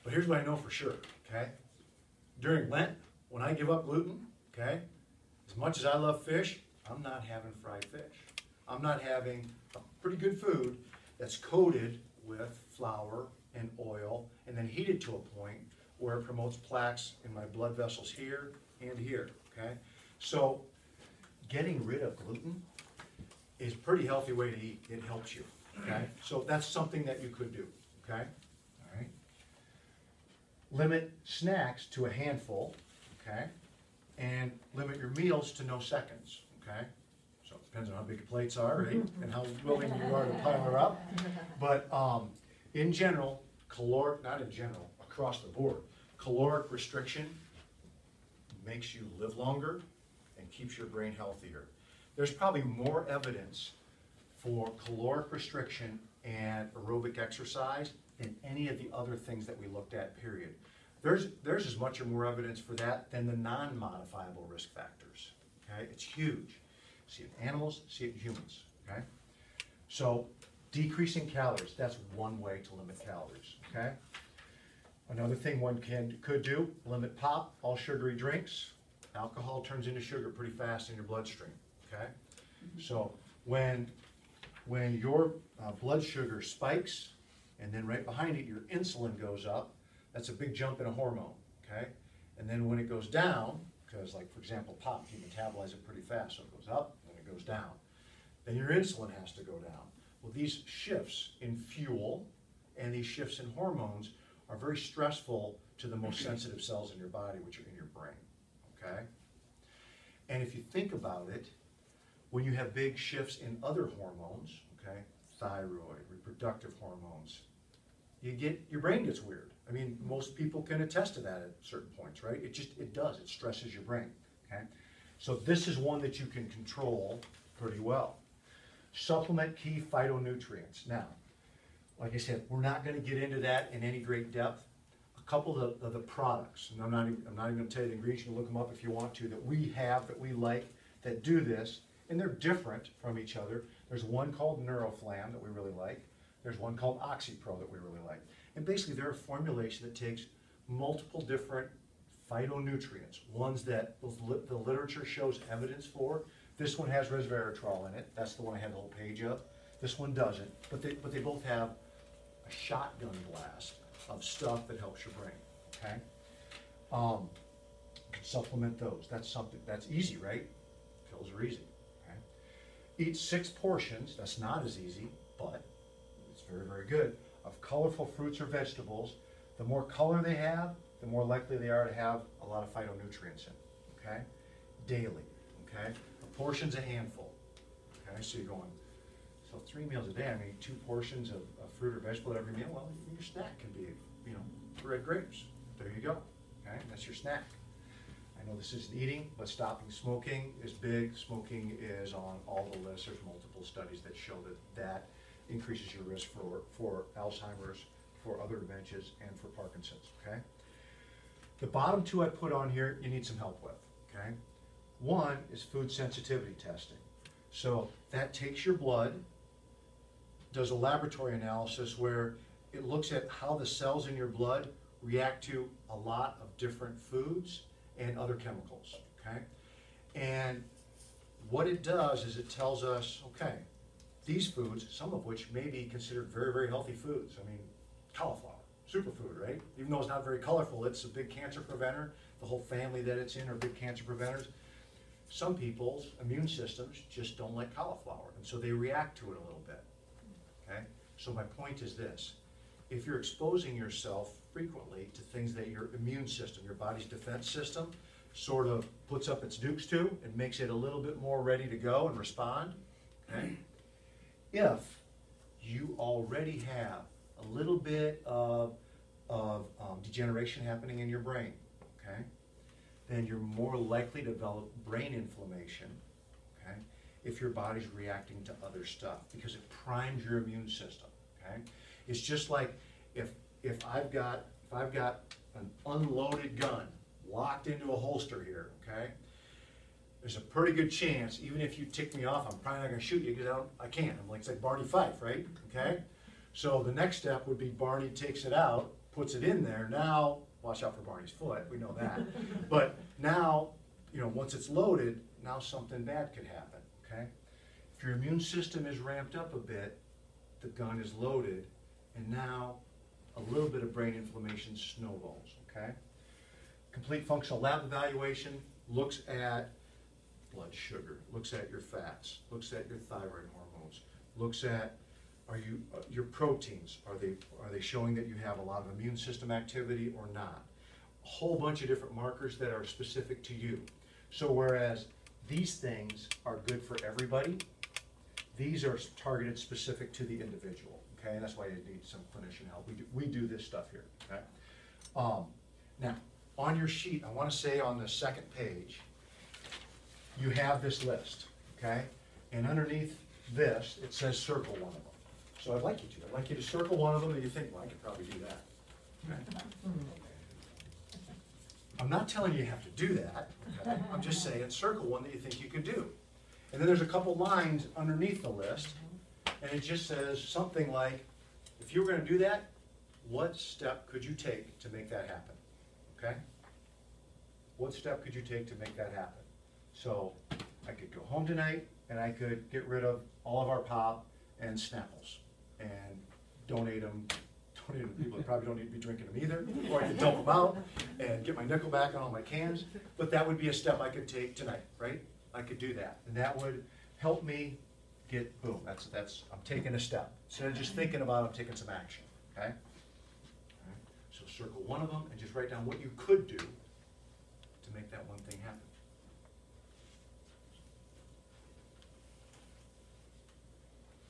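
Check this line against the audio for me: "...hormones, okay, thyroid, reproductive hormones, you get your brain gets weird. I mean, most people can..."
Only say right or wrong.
right.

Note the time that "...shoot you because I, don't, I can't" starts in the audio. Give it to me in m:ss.
4:53.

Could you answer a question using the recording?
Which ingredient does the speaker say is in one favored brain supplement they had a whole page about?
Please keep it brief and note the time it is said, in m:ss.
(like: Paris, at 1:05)
Resveratrol, at 2:37.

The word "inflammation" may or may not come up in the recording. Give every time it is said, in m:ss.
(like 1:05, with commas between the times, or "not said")
4:35, 5:14.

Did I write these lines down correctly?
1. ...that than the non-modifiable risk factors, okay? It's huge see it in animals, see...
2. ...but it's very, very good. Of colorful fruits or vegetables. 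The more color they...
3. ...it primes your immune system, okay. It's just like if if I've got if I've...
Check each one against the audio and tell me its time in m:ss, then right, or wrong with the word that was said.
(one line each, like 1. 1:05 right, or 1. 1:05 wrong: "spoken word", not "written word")
1. 1:02 right
2. 2:55 right
3. 4:39 right.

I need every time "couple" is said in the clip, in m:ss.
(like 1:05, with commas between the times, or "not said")
2:15, 6:07.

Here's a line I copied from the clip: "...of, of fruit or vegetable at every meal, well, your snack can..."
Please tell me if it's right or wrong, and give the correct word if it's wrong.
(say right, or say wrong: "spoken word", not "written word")
right.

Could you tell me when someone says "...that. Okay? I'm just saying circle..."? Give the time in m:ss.
6:03.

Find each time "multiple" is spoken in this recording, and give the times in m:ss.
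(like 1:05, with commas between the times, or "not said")
2:30, 3:23.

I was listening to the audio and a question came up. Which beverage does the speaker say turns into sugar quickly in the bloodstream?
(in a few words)
Alcohol.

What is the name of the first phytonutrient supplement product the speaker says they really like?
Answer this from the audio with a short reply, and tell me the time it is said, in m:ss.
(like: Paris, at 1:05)
Neuroflam, at 2:24.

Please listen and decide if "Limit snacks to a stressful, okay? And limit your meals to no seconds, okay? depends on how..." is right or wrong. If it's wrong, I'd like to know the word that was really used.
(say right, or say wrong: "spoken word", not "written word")
wrong: "handful", not "stressful".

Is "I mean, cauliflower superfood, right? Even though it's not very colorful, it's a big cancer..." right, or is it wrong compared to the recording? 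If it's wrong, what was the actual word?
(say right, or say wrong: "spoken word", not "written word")
right.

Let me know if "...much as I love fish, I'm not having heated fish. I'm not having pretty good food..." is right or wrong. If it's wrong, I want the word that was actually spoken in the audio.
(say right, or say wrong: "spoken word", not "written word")
wrong: "fried", not "heated".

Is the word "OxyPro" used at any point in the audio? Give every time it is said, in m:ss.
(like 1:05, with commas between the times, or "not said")
2:27.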